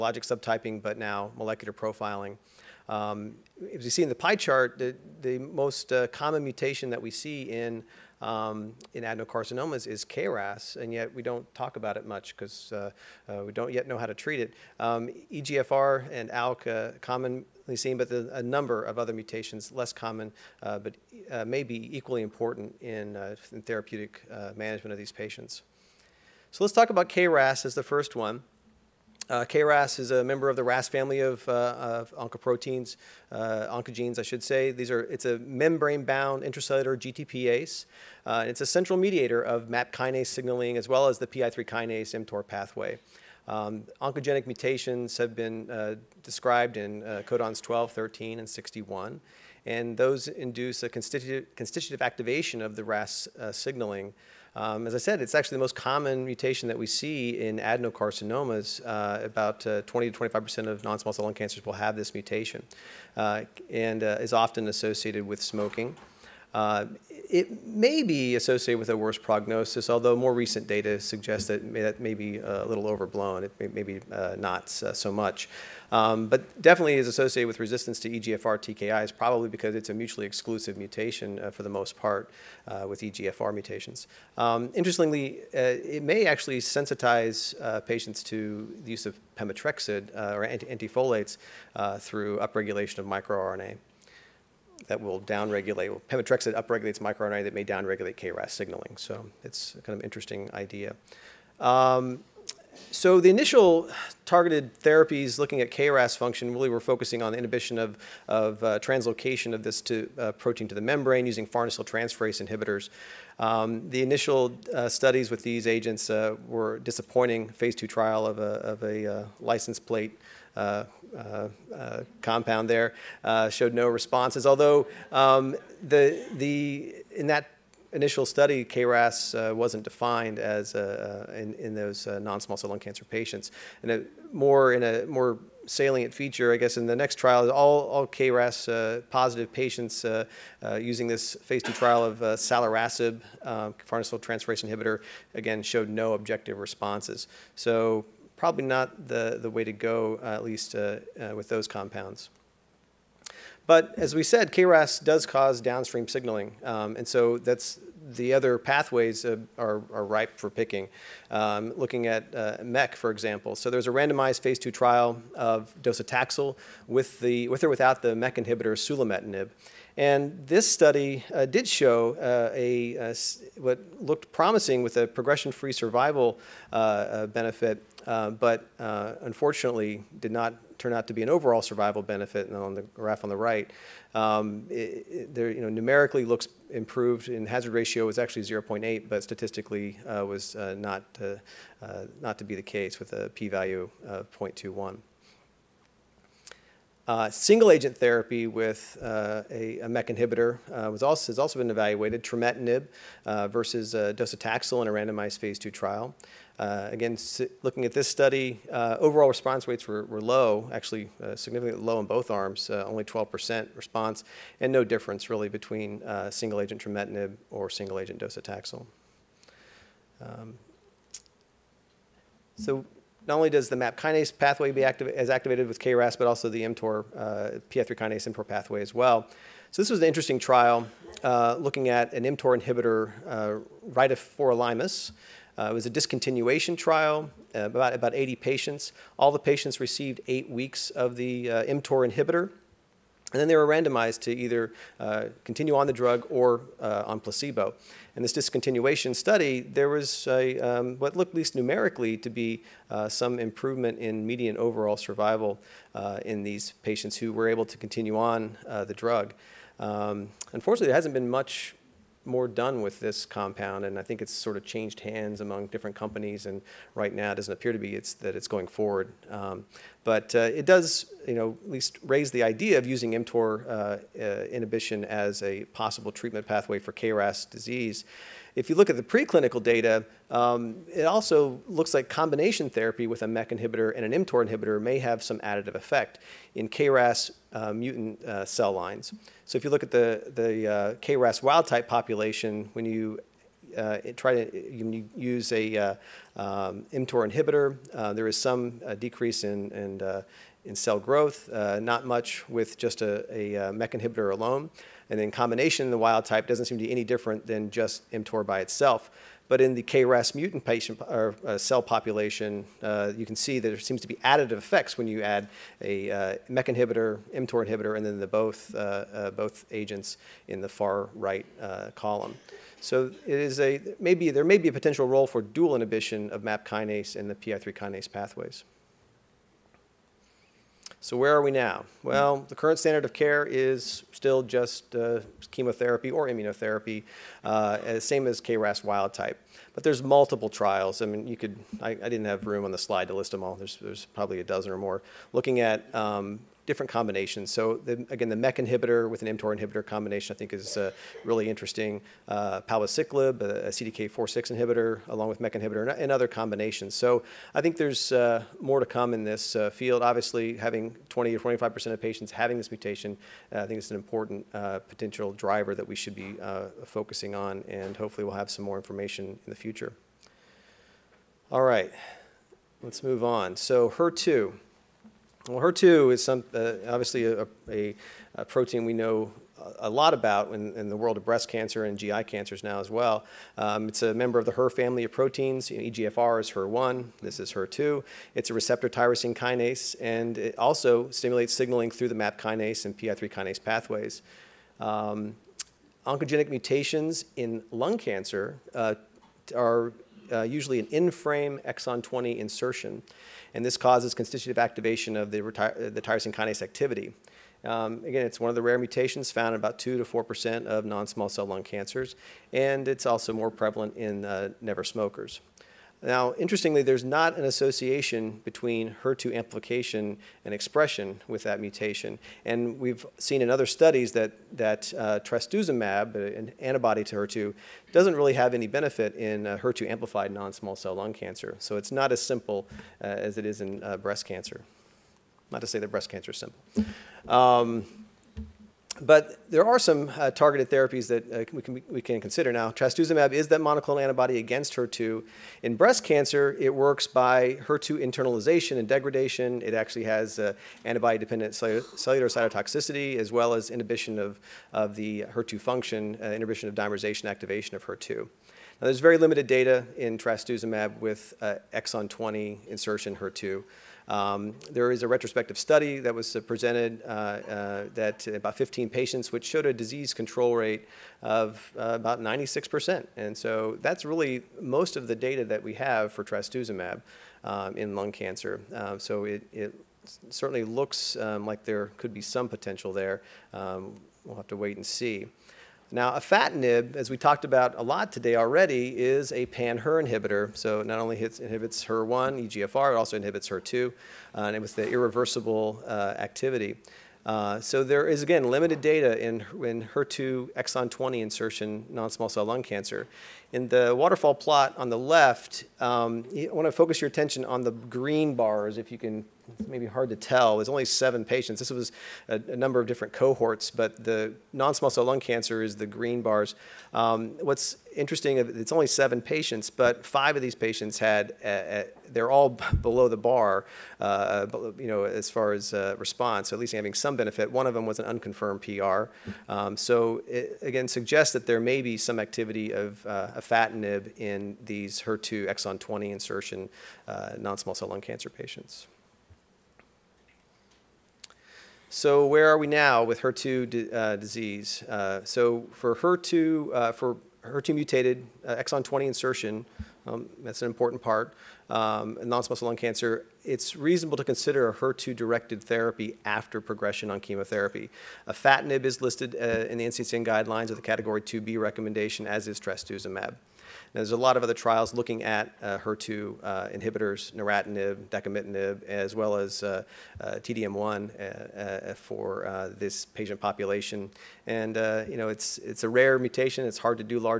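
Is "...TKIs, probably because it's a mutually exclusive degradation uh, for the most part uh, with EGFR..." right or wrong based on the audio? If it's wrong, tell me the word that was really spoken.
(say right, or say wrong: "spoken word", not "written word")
wrong: "mutation", not "degradation".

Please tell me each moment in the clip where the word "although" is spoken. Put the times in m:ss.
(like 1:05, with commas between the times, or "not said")
1:09, 2:04.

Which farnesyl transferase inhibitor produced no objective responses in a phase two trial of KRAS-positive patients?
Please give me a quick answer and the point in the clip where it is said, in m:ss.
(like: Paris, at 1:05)
salirasib, at 2:22.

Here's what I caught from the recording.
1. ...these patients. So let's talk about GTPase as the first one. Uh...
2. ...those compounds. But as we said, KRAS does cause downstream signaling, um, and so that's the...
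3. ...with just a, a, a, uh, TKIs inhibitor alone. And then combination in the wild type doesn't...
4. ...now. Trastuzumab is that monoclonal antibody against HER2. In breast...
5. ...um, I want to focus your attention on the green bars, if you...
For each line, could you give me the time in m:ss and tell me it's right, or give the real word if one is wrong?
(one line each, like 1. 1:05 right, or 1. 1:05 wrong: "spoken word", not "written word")
1. 0:24 wrong: "KRAS", not "GTPase"
2. 2:31 right
3. 5:02 wrong: "MEK", not "TKIs"
4. 7:22 right
5. 8:25 right.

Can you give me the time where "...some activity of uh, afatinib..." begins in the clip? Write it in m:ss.
8:51.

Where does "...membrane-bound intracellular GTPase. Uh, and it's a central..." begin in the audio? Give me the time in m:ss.
0:35.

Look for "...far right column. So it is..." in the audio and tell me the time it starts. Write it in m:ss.
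5:20.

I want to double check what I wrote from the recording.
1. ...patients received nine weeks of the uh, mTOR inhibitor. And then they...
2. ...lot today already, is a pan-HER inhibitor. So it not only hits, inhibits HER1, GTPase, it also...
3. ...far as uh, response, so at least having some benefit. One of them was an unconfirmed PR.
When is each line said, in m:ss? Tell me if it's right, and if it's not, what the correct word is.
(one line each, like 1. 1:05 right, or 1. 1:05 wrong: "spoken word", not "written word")
1. 3:59 wrong: "eight", not "nine"
2. 8:07 wrong: "EGFR", not "GTPase"
3. 8:45 right.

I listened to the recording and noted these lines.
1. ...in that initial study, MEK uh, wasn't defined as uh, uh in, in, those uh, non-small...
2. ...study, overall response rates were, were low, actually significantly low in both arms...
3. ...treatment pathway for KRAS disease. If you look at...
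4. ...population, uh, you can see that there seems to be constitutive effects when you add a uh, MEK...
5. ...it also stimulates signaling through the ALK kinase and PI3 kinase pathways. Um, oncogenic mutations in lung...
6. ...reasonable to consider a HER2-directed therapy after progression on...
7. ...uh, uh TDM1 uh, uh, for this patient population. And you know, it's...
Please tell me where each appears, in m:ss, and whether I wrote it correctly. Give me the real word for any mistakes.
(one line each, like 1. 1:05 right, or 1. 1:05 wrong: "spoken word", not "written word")
1. 2:07 wrong: "KRAS", not "MEK"
2. 3:28 right
3. 4:36 right
4. 5:11 wrong: "additive", not "constitutive"
5. 6:30 wrong: "MAP", not "ALK"
6. 9:13 right
7. 9:29 right.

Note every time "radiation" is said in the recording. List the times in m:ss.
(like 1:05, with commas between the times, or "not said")
not said.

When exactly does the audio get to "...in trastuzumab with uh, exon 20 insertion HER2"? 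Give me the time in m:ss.
7:39.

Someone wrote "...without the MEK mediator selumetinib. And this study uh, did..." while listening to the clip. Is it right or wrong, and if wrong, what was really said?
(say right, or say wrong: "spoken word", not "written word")
wrong: "inhibitor", not "mediator".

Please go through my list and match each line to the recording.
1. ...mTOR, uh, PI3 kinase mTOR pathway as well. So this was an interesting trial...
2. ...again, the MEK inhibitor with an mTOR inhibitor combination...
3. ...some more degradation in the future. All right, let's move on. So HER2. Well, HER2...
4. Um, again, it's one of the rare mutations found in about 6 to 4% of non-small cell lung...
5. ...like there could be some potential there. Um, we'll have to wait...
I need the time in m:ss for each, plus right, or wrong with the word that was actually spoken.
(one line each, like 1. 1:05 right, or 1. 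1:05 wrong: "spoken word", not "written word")
1. 3:46 right
2. 5:48 right
3. 6:08 wrong: "information", not "degradation"
4. 6:47 wrong: "2", not "6"
5. 8:01 right.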